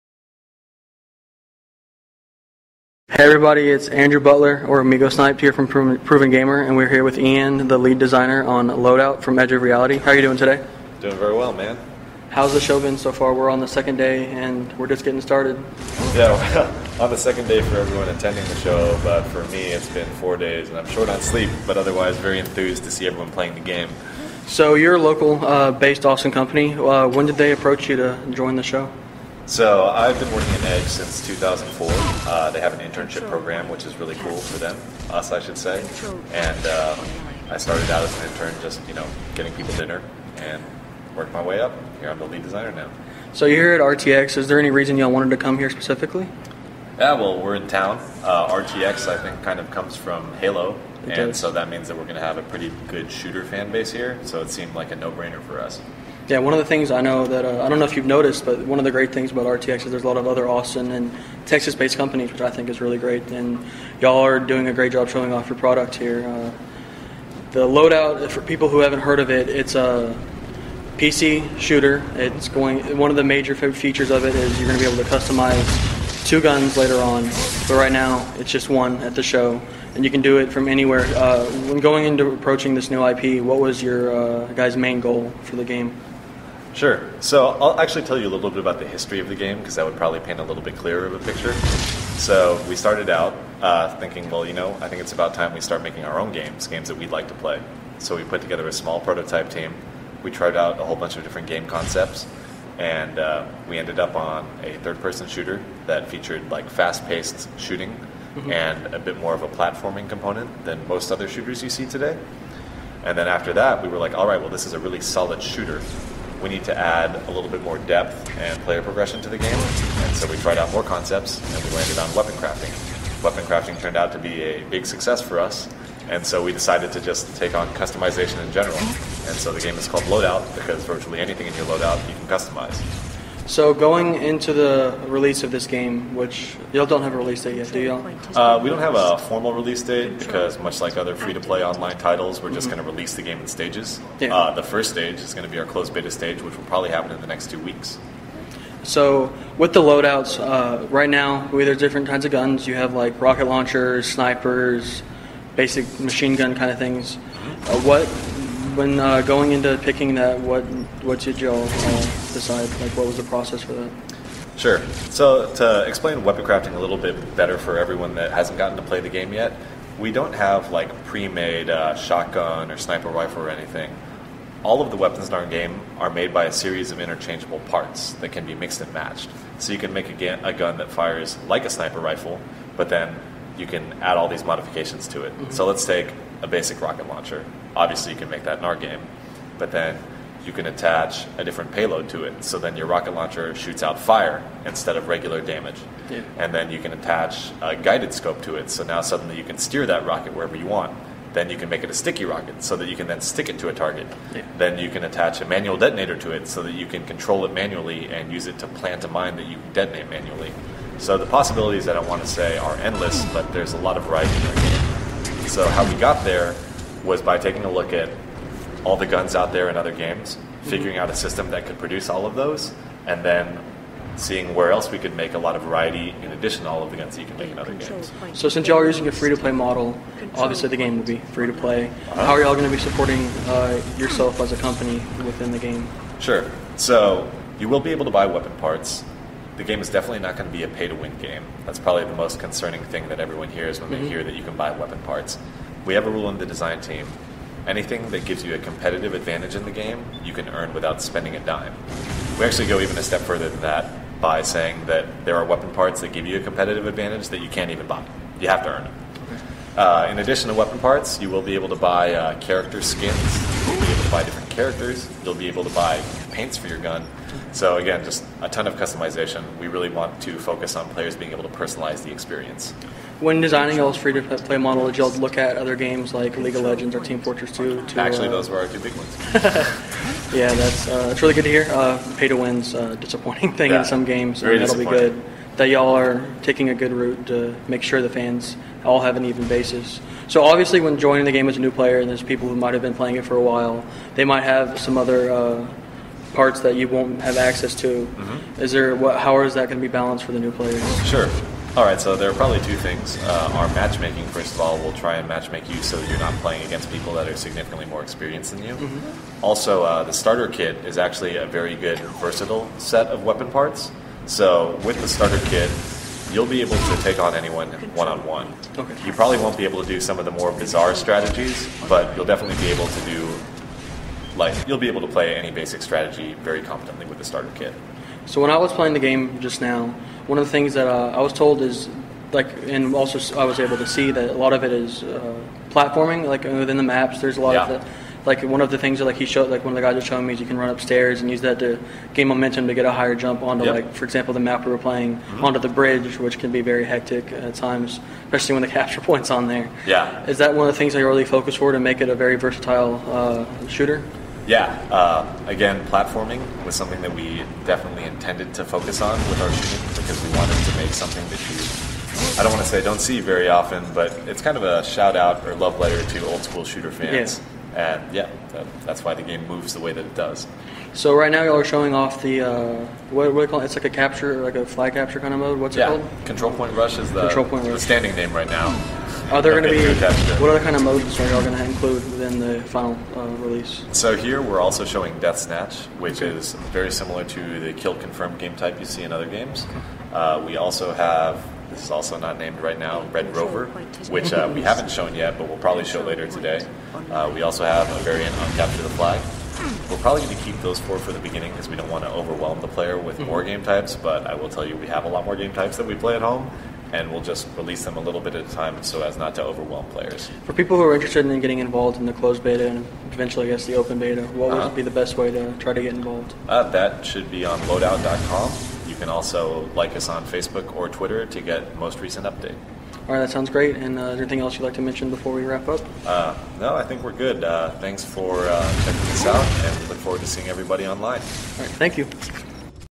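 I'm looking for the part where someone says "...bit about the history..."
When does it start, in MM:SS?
01:28.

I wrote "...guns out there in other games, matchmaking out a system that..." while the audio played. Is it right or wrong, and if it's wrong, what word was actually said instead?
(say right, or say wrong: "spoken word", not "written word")
wrong: "figuring", not "matchmaking".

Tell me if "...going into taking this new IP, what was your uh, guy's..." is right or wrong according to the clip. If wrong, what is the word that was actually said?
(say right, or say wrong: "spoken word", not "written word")
wrong: "approaching", not "taking".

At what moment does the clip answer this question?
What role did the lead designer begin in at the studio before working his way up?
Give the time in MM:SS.
00:38.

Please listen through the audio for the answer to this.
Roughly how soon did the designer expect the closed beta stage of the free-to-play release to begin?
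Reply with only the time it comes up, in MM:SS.
02:27.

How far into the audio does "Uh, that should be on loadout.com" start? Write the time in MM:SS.
06:56.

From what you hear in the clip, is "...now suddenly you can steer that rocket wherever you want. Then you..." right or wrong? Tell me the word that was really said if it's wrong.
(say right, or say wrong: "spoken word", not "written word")
right.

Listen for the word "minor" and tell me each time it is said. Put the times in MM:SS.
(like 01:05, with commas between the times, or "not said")
not said.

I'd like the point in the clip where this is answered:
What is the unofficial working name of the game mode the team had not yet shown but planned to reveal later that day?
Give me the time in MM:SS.
06:33.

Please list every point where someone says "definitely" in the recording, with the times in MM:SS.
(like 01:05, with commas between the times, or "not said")
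03:59, 05:22, 05:57.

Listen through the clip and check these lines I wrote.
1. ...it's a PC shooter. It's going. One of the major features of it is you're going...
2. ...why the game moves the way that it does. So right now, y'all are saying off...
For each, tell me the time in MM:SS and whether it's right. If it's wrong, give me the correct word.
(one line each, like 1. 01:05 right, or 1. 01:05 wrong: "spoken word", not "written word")
1. 01:09 right
2. 06:09 wrong: "showing", not "saying".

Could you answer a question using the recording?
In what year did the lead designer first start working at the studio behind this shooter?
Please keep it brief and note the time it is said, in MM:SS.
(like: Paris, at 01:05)
2004, at 00:31.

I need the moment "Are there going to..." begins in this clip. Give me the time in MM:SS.
06:19.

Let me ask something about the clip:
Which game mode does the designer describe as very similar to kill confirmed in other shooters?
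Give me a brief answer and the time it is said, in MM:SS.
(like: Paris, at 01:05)
Death Snatch, at 06:25.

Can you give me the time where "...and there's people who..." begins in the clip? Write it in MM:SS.
04:51.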